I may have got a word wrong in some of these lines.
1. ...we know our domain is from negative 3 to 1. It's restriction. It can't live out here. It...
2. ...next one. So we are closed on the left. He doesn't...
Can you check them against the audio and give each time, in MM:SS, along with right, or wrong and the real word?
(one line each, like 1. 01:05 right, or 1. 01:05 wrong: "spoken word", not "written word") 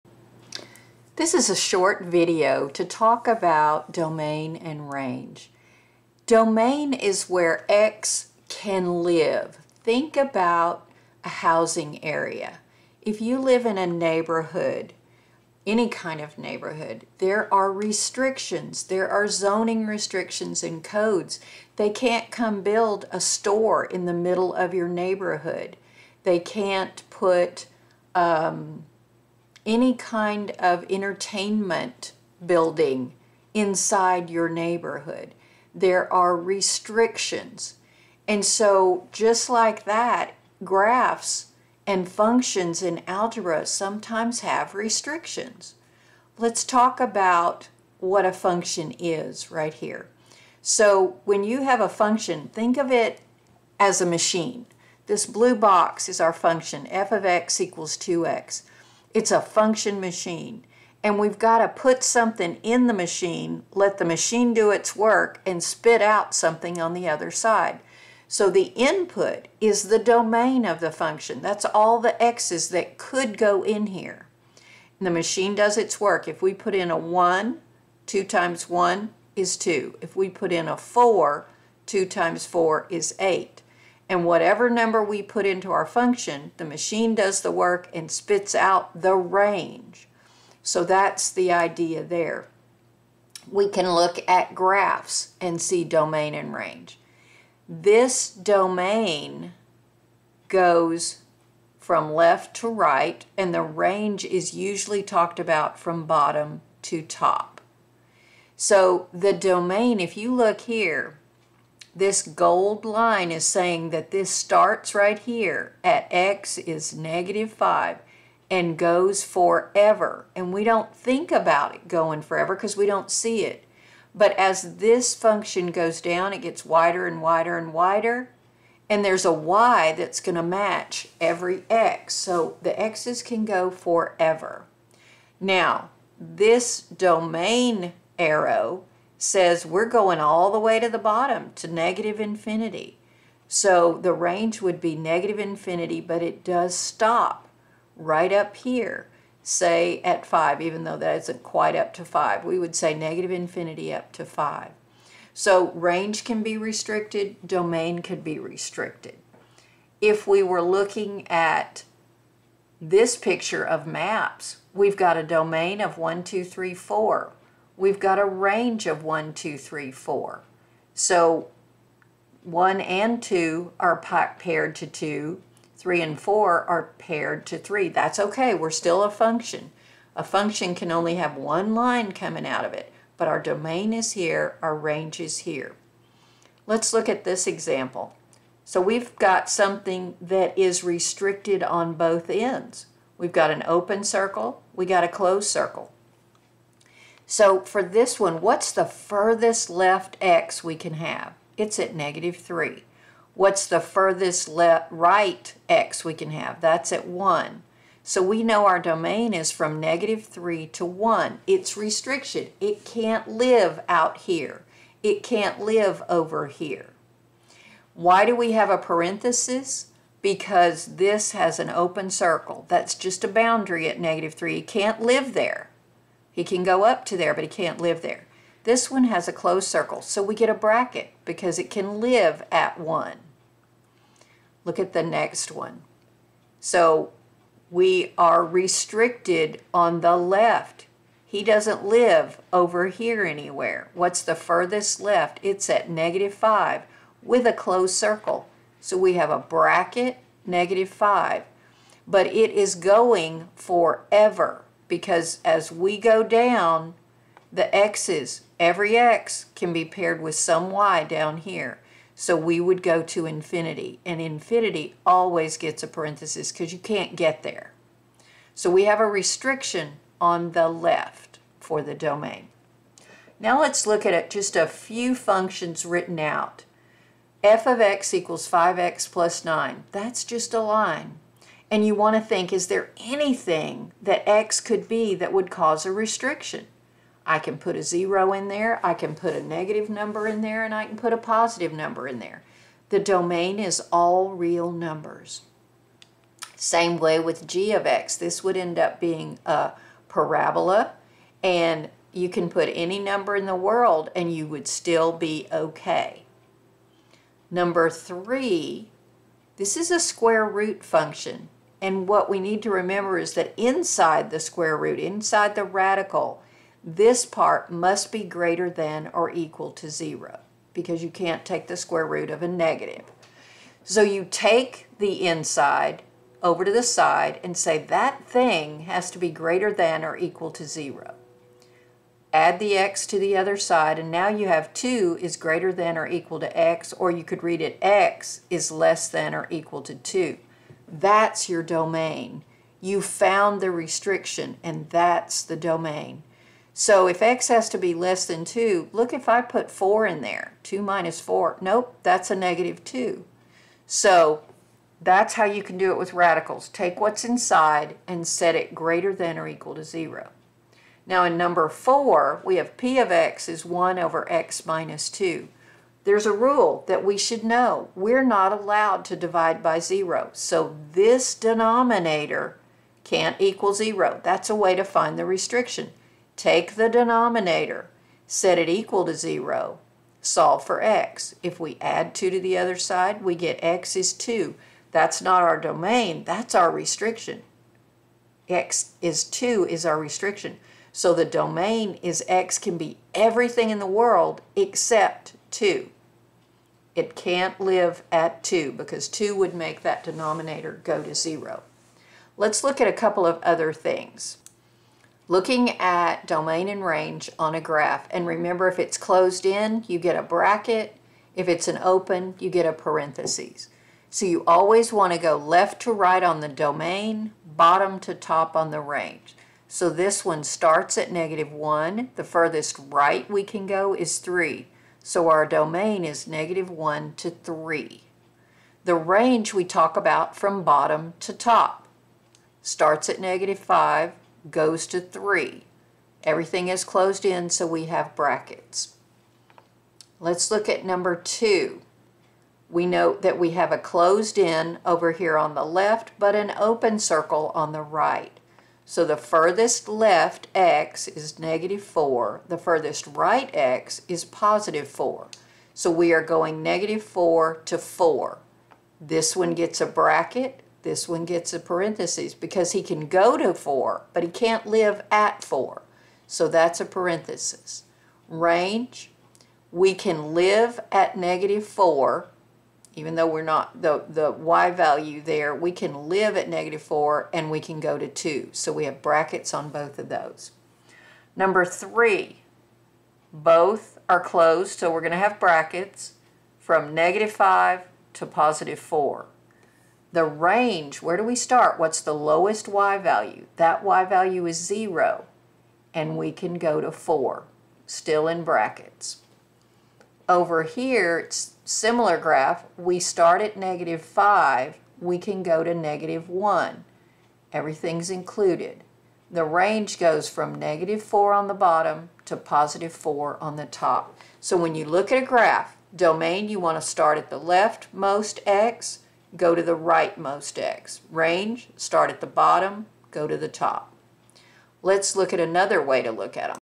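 1. 03:28 right
2. 03:55 wrong: "restricted", not "closed".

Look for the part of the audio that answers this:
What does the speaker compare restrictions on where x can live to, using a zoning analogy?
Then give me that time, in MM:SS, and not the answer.
00:11.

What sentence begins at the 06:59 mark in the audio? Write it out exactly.
So this one starts at negative 1.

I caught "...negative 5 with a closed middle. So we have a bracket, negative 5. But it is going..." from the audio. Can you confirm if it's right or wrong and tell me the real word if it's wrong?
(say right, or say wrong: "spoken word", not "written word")
wrong: "circle", not "middle".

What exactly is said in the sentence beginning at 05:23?
So you take the inside over to the side and say that thing has to be greater than or equal to zero.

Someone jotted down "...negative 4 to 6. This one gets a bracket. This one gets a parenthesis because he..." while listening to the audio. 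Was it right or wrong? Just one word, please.
wrong.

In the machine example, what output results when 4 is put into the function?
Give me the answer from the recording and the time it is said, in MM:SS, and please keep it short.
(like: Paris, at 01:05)
8, at 01:23.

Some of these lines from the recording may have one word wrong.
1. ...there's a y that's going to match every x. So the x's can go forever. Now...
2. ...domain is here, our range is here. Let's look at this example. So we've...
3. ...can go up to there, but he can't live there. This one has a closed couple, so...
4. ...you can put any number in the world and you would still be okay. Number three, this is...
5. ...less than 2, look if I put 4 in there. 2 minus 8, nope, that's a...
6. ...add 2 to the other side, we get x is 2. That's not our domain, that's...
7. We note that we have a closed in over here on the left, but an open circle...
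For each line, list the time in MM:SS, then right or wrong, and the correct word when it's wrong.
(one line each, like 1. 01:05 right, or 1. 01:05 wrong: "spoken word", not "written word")
1. 02:09 right
2. 03:03 right
3. 03:46 wrong: "circle", not "couple"
4. 05:02 right
5. 05:47 wrong: "4", not "8"
6. 06:21 right
7. 07:22 right.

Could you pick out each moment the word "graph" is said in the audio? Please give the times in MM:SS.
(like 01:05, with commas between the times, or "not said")
00:40, 01:34, 06:47, 08:22, 08:35.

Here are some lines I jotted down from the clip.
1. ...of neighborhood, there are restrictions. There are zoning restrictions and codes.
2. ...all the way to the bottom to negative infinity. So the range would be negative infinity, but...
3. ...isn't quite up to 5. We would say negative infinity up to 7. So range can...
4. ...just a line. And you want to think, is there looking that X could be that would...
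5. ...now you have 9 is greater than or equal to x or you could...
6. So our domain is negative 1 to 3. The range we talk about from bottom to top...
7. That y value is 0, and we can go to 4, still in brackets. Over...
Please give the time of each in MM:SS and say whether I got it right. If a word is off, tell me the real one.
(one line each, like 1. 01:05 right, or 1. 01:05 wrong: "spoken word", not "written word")
1. 00:16 right
2. 02:20 right
3. 02:31 wrong: "5", not "7"
4. 04:40 wrong: "anything", not "looking"
5. 05:34 wrong: "2", not "9"
6. 07:05 right
7. 08:13 right.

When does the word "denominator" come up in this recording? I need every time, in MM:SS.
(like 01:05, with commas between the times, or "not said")
06:11, 06:16, 06:40.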